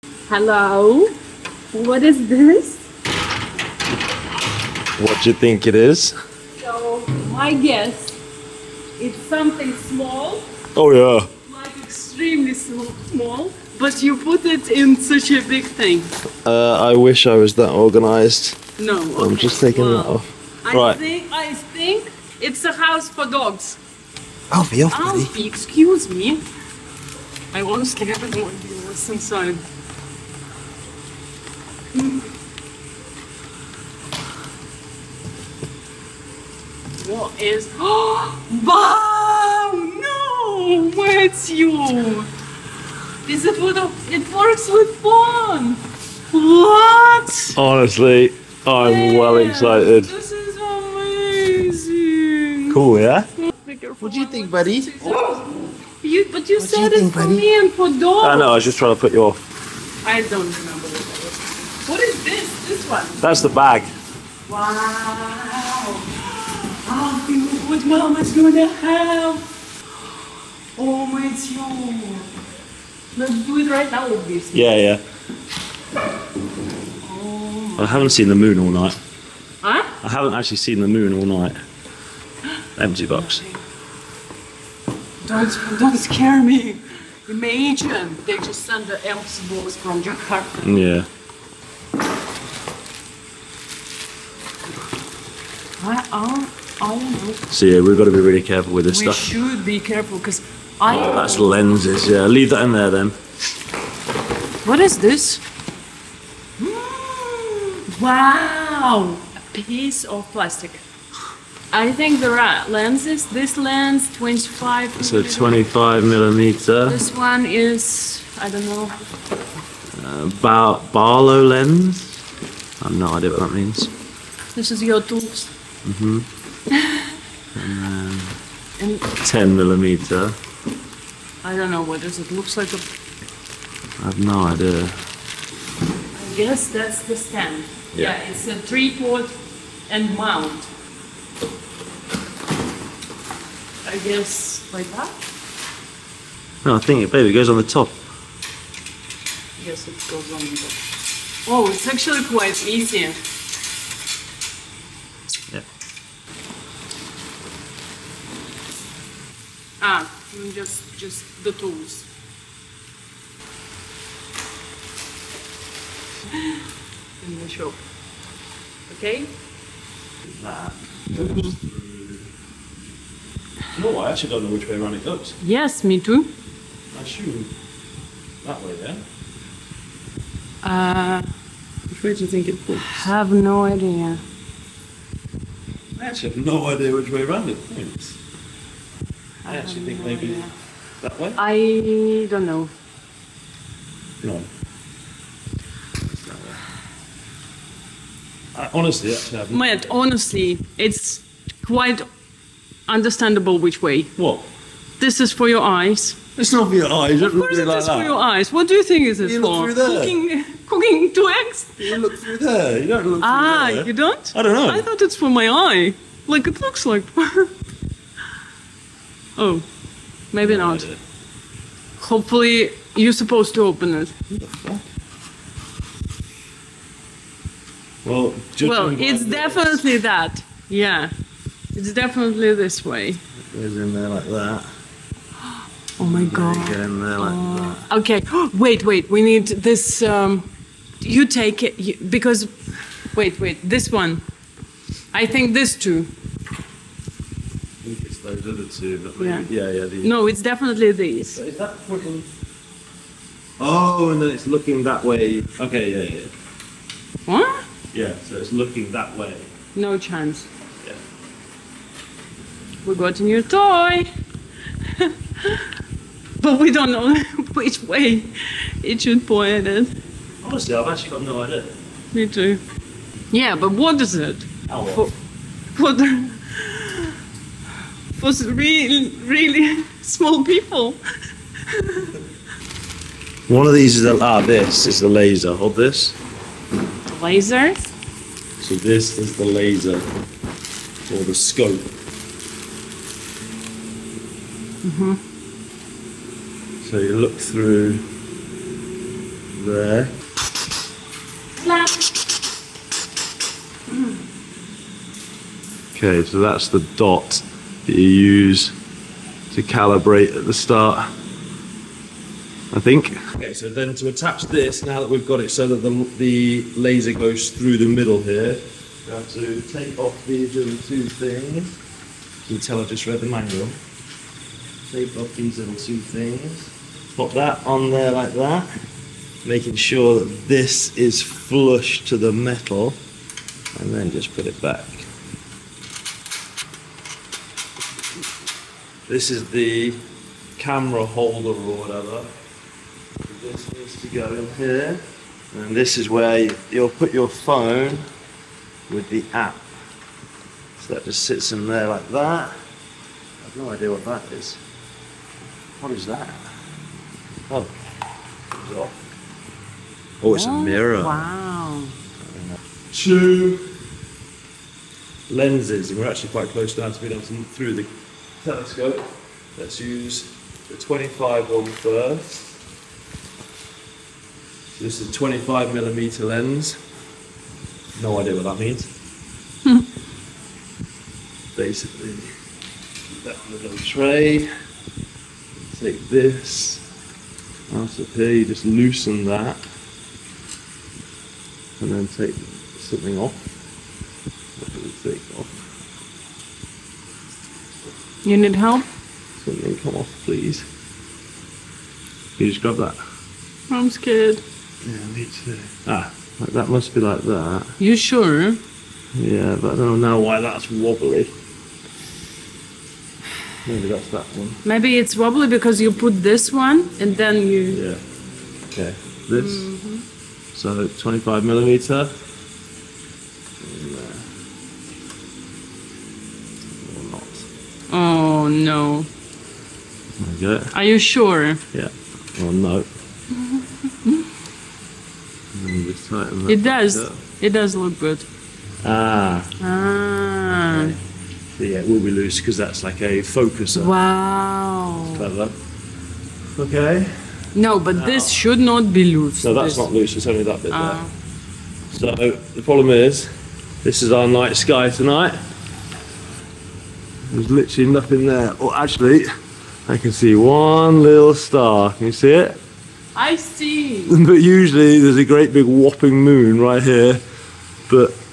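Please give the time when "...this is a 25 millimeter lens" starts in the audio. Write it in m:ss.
6:14.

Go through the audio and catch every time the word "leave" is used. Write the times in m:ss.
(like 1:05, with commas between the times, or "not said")
1:42.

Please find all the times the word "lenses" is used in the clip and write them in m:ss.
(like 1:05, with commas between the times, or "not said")
1:41, 1:52, 6:05.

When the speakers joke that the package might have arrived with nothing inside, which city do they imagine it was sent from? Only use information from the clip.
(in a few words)
Jakarta.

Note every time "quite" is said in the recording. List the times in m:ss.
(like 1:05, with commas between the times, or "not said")
2:32, 3:21, 6:06.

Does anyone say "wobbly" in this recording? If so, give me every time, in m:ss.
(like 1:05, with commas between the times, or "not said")
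6:50, 6:55.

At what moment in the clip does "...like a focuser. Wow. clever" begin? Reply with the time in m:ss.
7:22.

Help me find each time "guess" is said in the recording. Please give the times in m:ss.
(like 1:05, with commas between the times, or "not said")
0:07, 2:16, 2:24.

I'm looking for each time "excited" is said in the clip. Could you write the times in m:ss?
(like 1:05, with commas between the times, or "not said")
0:49.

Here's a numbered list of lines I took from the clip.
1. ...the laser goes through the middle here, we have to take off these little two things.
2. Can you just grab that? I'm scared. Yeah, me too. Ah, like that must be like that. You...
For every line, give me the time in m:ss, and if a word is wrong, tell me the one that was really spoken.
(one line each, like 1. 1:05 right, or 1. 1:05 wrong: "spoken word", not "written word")
1. 5:16 right
2. 6:42 right.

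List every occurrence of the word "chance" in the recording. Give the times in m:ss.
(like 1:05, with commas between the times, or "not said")
4:19.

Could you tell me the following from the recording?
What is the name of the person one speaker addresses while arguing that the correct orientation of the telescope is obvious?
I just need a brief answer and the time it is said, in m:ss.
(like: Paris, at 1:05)
Matt, at 3:19.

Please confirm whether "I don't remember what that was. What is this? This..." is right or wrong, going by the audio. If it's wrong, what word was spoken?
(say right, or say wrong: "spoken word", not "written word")
right.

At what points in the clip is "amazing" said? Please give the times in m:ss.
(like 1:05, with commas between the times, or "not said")
0:50.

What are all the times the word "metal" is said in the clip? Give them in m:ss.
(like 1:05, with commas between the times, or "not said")
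5:32.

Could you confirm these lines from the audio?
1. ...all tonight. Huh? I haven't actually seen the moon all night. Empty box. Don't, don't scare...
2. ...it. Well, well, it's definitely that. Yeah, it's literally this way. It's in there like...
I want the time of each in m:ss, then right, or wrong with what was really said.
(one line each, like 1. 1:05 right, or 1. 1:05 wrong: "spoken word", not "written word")
1. 1:18 wrong: "night", not "tonight"
2. 3:43 wrong: "definitely", not "literally".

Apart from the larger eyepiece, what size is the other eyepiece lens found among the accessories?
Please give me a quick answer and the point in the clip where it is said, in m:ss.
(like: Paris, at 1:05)
10 millimeter, at 2:09.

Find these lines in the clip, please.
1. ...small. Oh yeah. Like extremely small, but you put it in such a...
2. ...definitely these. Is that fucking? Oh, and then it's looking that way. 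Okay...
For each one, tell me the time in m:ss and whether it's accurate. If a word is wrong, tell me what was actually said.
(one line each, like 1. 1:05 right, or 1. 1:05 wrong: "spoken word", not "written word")
1. 0:09 right
2. 4:10 right.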